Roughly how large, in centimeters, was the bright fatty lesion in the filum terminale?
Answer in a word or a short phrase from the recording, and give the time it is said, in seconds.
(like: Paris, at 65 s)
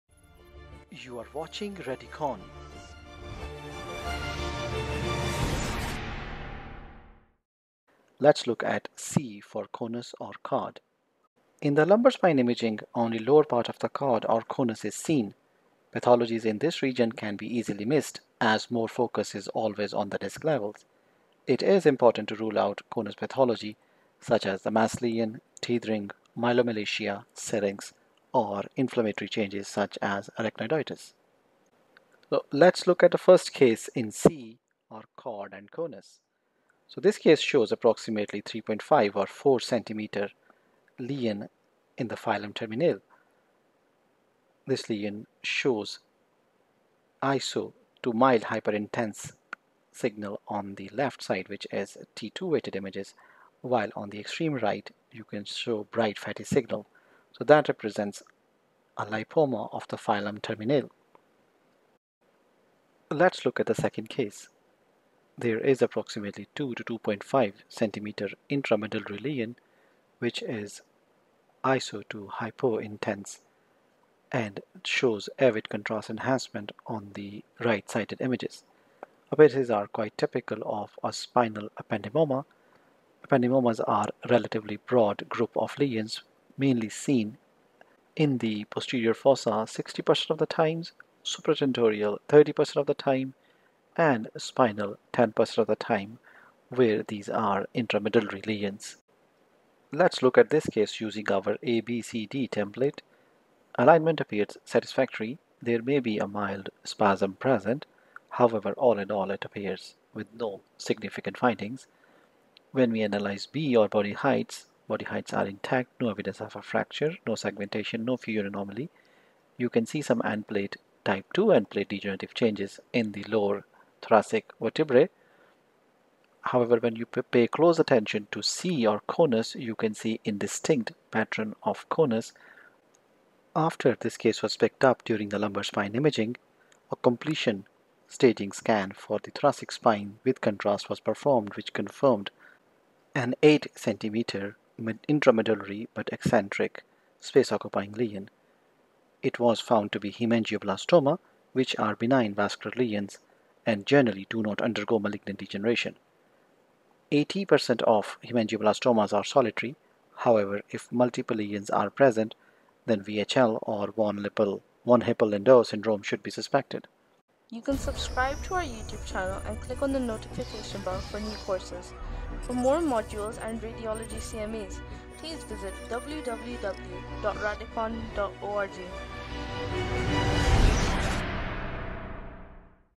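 3.5 or 4 centimeters, at 38 s.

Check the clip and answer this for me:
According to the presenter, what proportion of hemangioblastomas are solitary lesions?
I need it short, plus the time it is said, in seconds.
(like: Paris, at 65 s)
80%, at 157 s.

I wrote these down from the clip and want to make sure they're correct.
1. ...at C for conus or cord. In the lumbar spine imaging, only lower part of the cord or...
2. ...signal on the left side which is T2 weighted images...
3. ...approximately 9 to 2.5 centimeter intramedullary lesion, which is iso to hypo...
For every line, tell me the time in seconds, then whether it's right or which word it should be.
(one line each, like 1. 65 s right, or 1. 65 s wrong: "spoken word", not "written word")
1. 8 s right
2. 49 s right
3. 65 s wrong: "2", not "9".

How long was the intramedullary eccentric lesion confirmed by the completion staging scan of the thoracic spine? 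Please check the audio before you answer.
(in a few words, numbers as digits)
8 centimeters.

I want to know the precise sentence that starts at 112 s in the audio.
When we analyze B or body heights, Body heights are intact, no evidence of a fracture, no segmentation, no fissure anomaly.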